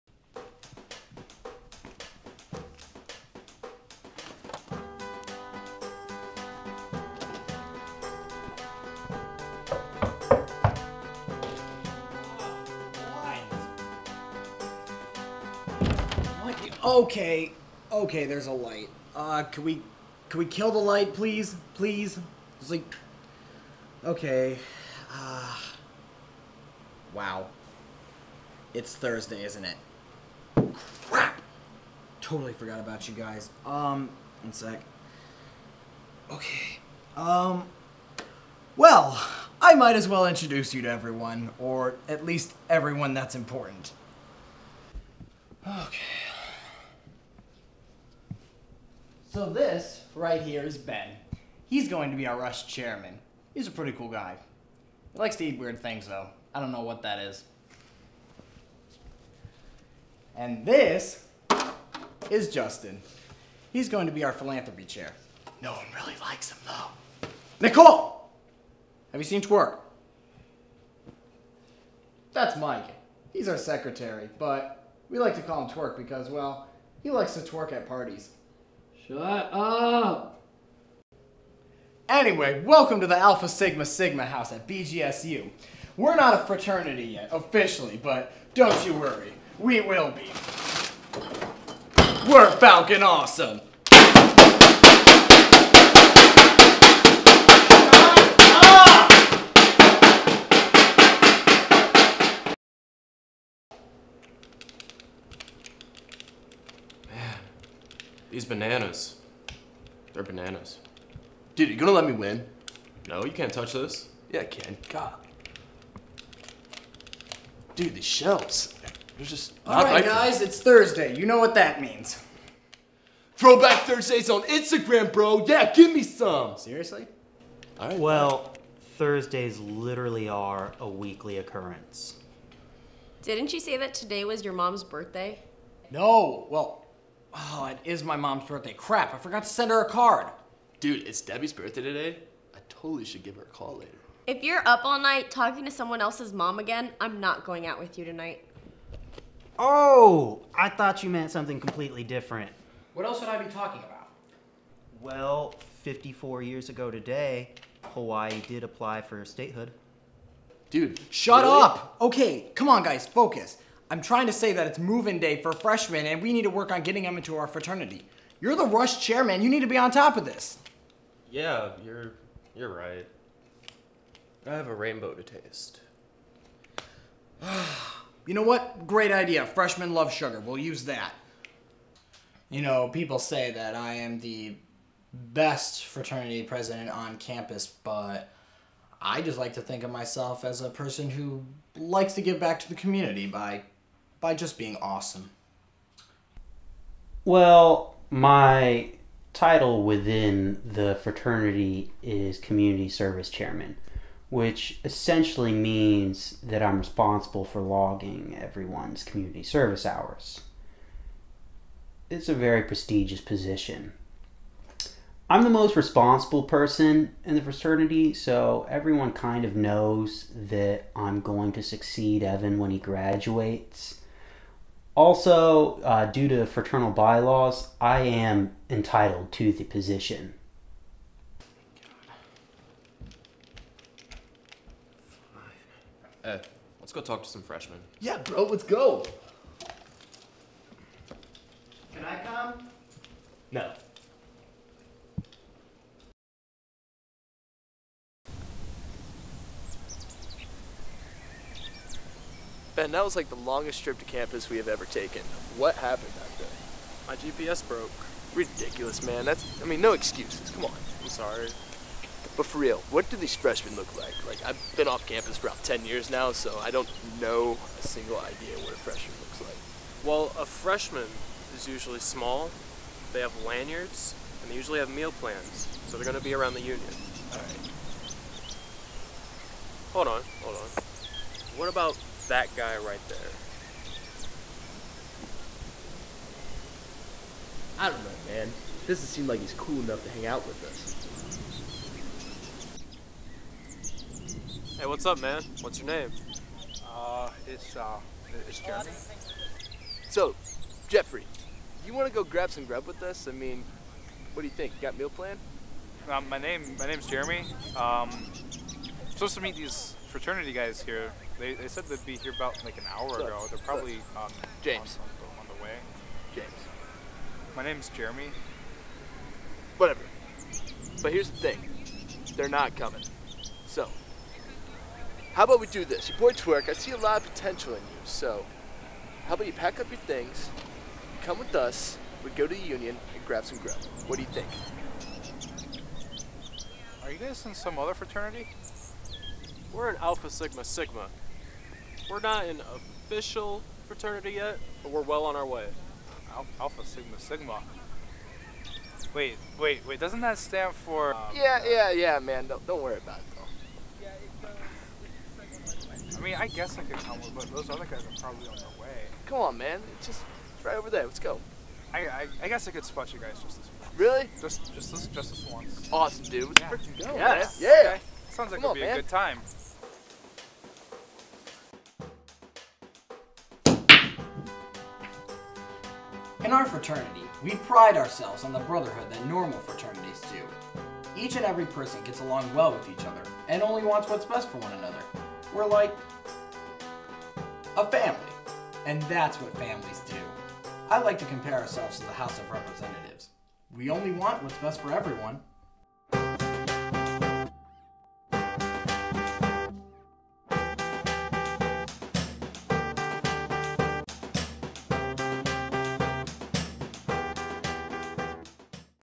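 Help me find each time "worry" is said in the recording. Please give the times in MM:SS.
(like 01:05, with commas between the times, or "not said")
01:28, 05:52.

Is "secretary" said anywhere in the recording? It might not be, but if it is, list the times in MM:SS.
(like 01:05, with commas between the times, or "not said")
01:13.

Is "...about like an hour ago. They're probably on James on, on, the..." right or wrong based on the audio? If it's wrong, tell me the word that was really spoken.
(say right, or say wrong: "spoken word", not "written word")
right.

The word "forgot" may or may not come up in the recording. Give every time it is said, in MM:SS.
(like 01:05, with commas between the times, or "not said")
00:32, 02:19.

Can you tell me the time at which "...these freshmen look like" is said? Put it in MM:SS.
04:23.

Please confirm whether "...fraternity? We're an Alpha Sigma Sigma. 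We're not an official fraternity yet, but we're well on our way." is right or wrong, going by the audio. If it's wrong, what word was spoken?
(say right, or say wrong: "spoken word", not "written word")
right.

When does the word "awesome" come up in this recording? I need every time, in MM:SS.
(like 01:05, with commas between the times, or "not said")
01:33, 03:14, 06:05.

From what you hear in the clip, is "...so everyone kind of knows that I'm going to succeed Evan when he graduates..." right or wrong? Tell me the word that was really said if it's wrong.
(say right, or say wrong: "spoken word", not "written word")
right.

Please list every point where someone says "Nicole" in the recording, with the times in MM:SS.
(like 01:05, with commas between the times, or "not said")
01:07.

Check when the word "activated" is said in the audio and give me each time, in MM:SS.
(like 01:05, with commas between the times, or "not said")
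not said.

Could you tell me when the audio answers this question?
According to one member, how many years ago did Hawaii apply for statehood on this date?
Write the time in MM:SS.
02:35.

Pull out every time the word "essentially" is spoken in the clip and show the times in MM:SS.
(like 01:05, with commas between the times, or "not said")
03:24.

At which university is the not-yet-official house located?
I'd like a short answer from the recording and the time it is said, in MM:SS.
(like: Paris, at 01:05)
BGSU, at 01:24.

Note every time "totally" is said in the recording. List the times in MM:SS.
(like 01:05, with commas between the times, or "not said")
00:32, 02:22.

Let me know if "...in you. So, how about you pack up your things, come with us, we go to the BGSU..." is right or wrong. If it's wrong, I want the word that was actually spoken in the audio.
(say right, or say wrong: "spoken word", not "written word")
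wrong: "Union", not "BGSU".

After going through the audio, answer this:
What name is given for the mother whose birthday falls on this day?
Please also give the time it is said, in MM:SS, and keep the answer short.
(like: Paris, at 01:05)
Debbie, at 02:21.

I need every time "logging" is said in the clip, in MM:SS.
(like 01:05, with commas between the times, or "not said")
03:27.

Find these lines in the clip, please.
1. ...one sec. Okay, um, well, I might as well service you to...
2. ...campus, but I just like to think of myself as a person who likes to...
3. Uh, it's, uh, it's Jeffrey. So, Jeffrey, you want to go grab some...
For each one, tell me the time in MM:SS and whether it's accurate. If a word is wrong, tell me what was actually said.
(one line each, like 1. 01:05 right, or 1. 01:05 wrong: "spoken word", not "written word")
1. 00:34 wrong: "introduce", not "service"
2. 03:07 right
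3. 04:56 right.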